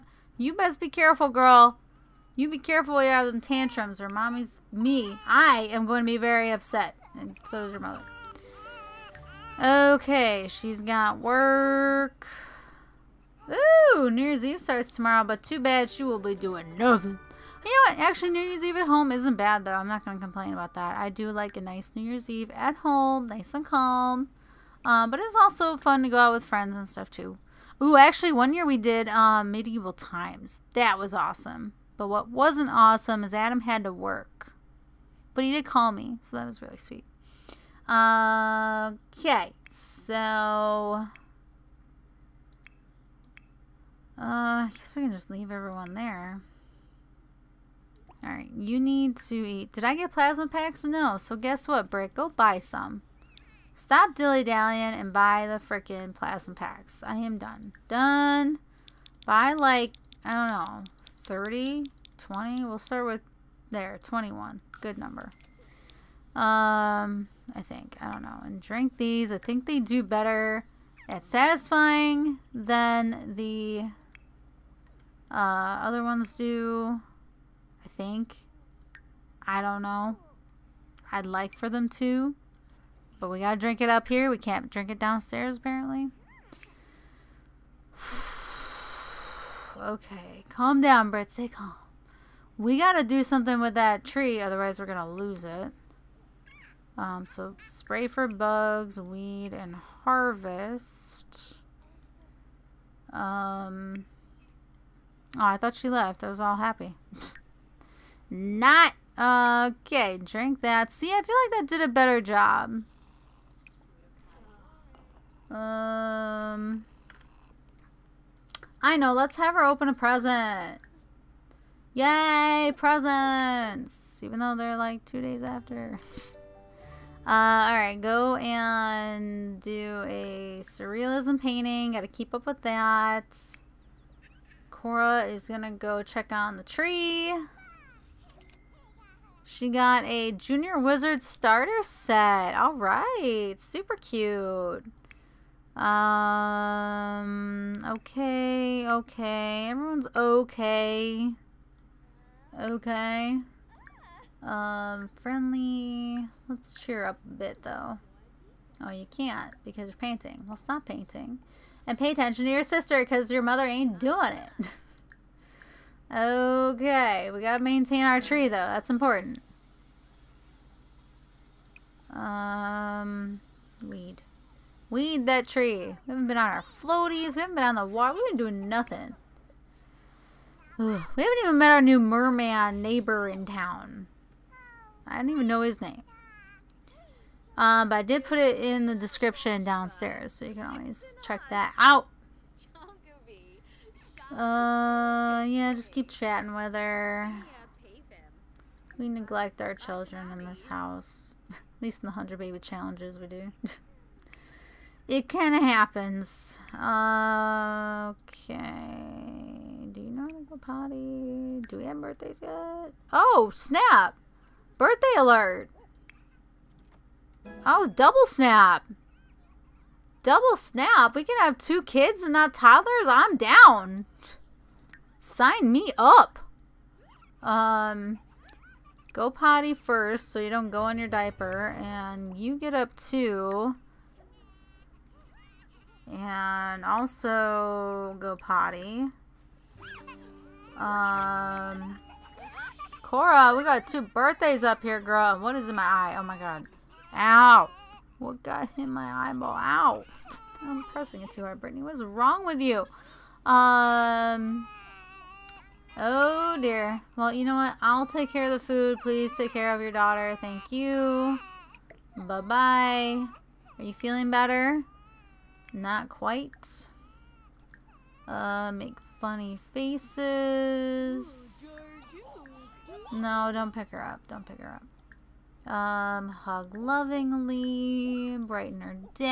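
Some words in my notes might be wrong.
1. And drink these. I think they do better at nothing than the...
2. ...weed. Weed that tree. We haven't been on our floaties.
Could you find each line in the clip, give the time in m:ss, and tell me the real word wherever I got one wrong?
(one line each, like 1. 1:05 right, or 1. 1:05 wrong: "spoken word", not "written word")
1. 1:08 wrong: "satisfying", not "nothing"
2. 2:53 right.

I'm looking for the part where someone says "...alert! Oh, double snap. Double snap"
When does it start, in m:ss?
3:35.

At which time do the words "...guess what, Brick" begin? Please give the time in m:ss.
0:51.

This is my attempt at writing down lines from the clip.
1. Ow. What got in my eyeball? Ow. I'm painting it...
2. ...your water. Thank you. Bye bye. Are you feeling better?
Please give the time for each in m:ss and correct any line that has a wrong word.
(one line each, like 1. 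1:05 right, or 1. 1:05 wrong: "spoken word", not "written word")
1. 4:07 wrong: "pressing", not "painting"
2. 4:19 wrong: "daughter", not "water".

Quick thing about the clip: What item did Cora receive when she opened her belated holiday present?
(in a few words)
Junior Wizard starter set.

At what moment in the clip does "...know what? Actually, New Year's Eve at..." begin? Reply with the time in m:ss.
0:17.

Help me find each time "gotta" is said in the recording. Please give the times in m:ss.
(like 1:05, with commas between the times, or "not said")
1:23, 1:32, 2:11, 2:47.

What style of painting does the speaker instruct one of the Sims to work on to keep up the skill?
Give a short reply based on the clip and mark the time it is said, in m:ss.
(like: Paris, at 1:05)
surrealism, at 2:10.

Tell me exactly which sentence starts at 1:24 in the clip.
We can't drink it downstairs, apparently.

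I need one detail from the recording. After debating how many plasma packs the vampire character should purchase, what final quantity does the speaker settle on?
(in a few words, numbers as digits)
21.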